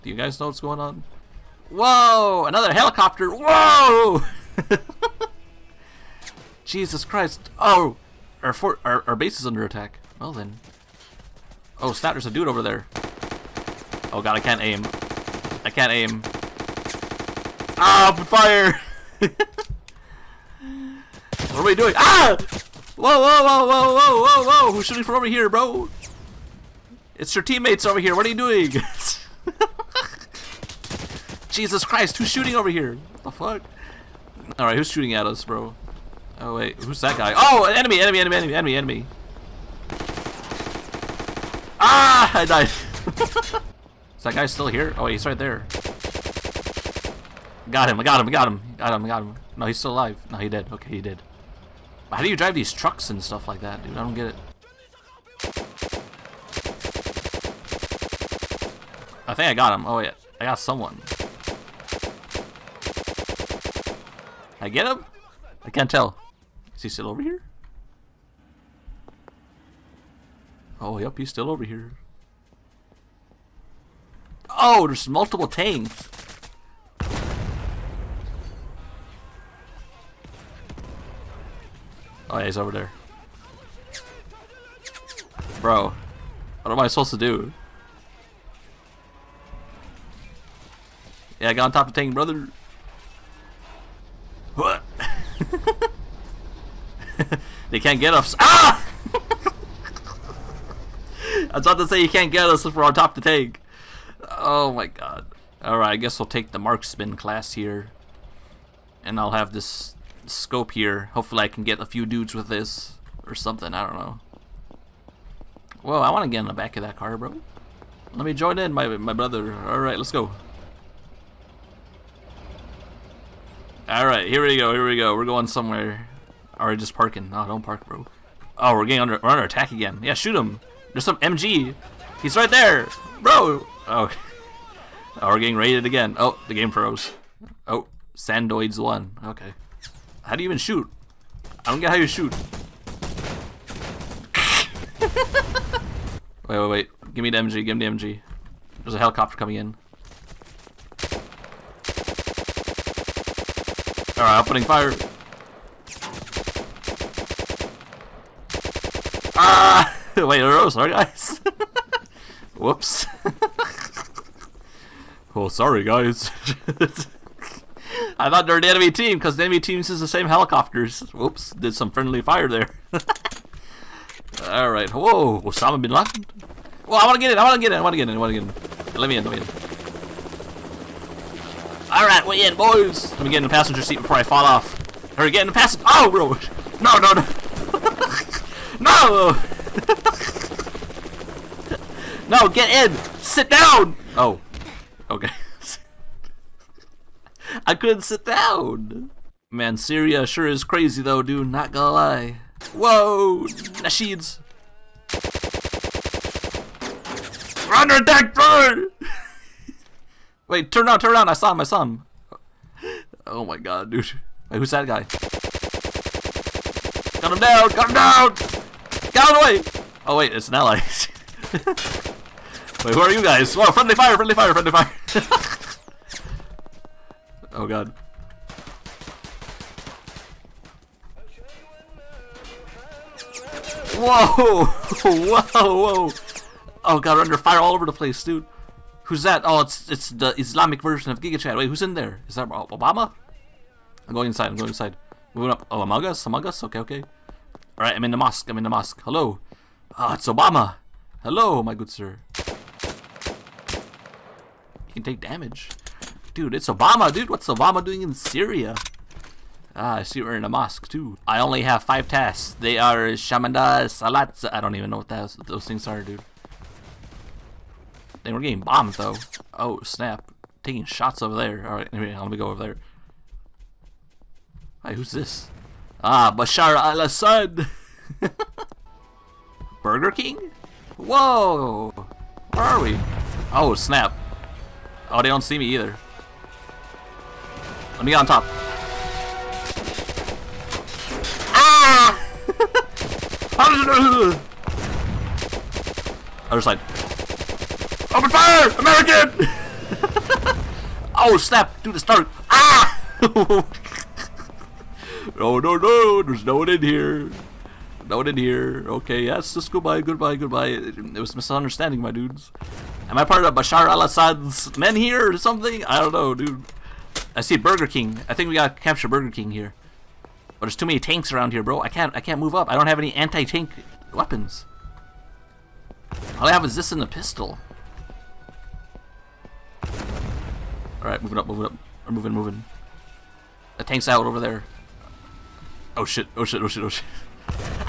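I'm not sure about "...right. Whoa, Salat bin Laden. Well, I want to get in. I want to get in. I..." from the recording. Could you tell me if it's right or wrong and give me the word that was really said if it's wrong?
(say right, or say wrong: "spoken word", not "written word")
wrong: "Osama", not "Salat".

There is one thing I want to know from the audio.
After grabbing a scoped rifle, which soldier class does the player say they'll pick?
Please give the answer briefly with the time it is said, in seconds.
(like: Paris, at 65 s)
marksman, at 106 s.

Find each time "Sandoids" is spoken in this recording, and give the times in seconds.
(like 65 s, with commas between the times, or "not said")
138 s.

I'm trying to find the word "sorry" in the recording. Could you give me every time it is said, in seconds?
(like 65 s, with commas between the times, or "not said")
160 s, 165 s.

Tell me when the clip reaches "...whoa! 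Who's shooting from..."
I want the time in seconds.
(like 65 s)
24 s.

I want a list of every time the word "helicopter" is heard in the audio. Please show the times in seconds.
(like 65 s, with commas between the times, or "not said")
2 s, 148 s, 170 s.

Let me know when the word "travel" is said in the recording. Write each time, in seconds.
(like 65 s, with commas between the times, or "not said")
not said.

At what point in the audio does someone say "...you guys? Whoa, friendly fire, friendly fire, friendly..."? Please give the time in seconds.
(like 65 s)
223 s.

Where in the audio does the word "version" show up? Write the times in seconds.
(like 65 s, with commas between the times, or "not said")
240 s.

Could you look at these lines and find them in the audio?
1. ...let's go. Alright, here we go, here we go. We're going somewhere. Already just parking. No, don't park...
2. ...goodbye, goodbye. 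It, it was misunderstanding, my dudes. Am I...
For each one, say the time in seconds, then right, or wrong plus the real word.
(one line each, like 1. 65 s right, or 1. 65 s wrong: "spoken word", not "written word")
1. 119 s right
2. 310 s right.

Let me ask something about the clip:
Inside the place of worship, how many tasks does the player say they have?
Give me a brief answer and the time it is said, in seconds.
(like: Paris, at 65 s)
5, at 261 s.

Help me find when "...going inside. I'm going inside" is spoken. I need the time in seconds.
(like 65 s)
244 s.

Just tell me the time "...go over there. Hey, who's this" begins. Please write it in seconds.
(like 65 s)
272 s.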